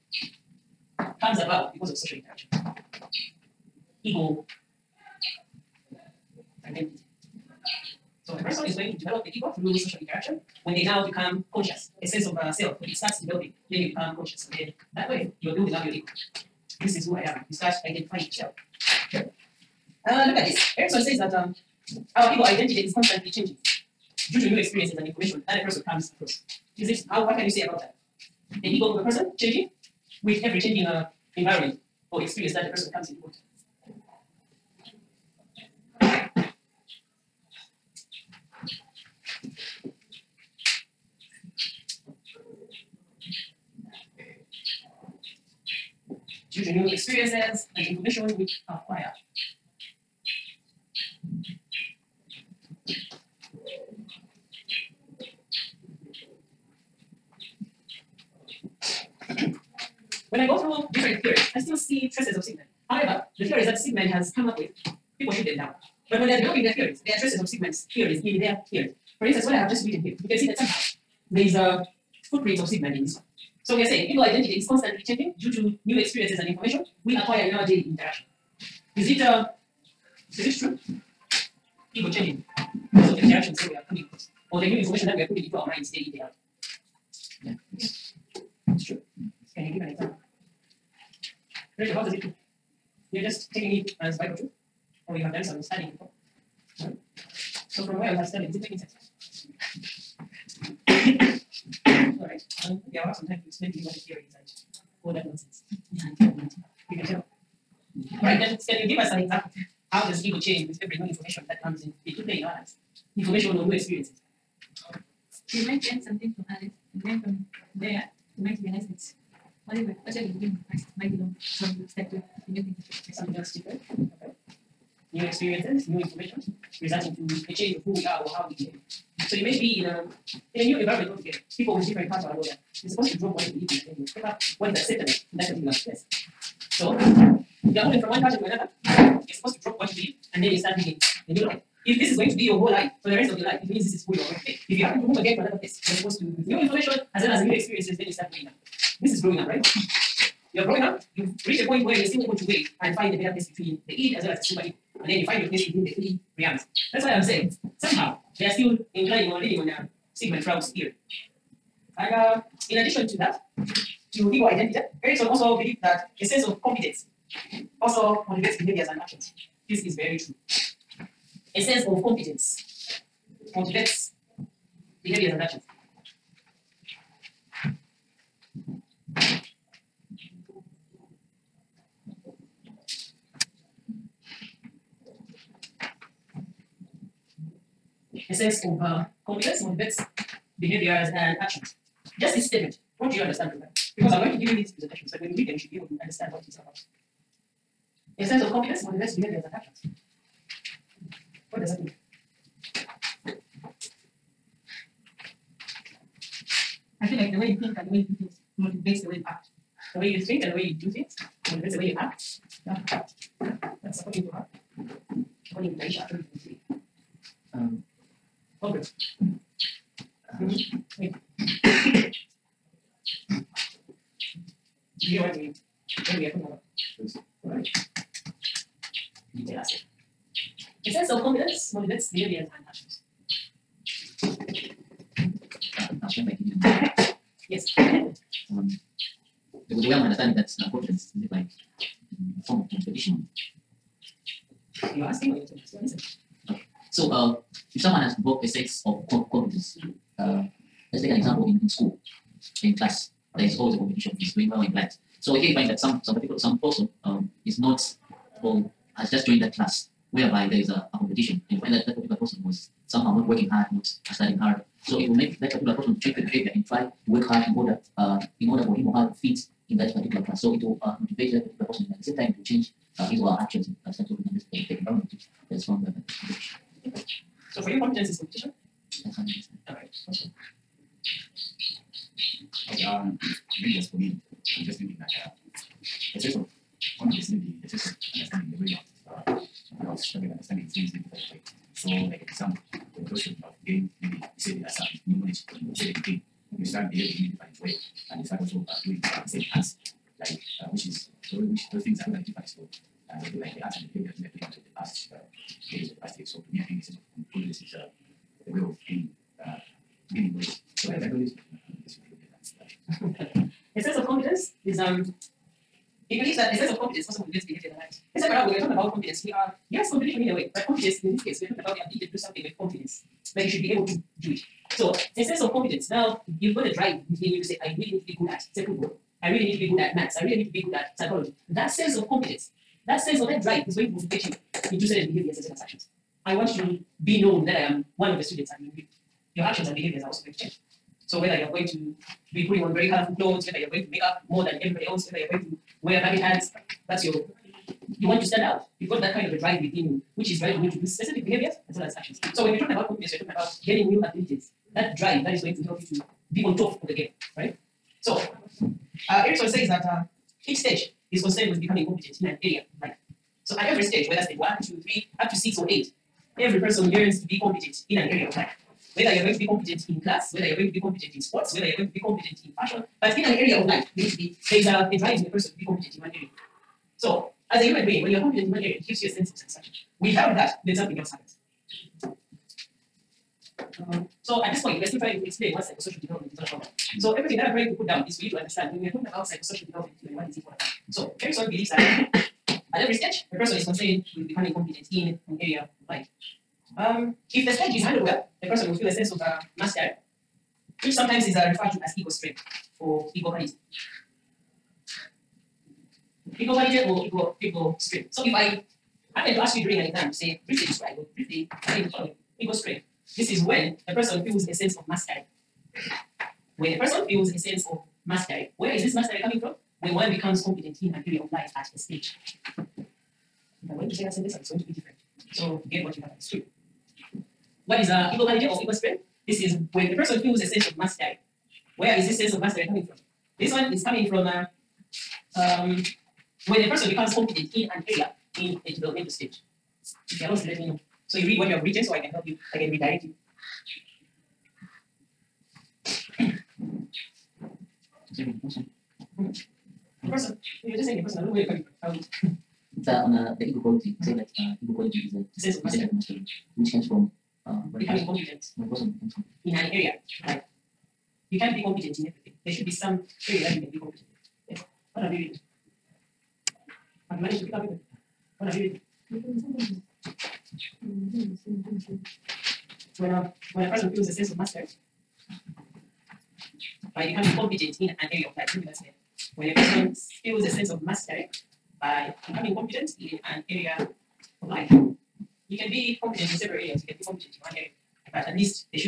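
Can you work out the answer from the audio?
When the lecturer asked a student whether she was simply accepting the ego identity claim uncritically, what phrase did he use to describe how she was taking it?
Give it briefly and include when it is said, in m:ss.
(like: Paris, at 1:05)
Bible truth, at 1:34.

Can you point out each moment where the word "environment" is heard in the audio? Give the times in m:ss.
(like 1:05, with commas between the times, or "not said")
0:31, 2:10, 4:34.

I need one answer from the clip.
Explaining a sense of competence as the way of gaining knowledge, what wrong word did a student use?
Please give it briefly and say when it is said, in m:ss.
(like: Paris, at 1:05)
holiness, at 5:07.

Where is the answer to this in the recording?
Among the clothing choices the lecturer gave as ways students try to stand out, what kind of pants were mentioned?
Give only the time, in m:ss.
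5:46.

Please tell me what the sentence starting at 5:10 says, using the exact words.
So I like knowledge a sense of confidence is um, it believes that a sense of competence also motivates behavior in life.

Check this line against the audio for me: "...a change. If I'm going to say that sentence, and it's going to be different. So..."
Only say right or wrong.
wrong.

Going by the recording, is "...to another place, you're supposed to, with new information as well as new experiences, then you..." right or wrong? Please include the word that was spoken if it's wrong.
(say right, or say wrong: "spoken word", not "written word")
right.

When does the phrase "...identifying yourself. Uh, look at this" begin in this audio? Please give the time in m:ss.
0:17.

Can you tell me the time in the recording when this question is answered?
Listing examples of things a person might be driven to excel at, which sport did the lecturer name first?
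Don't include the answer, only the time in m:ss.
5:28.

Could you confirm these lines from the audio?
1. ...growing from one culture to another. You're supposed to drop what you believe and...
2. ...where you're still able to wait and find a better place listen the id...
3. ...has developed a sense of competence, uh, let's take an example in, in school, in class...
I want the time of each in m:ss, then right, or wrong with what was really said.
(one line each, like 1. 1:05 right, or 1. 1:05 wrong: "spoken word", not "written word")
1. 2:17 wrong: "moving", not "growing"
2. 2:31 wrong: "between", not "listen"
3. 4:07 right.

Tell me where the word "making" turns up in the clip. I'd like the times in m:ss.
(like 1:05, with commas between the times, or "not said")
1:38.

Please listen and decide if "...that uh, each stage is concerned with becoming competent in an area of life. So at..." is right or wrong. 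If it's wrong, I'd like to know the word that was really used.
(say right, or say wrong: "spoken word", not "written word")
right.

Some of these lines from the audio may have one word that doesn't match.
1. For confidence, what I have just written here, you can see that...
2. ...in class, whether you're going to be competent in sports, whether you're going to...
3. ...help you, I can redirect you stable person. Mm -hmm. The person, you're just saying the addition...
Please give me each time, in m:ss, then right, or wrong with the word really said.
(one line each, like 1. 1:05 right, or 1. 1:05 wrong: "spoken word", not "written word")
1. 1:09 wrong: "instance", not "confidence"
2. 6:09 right
3. 7:22 wrong: "person", not "addition".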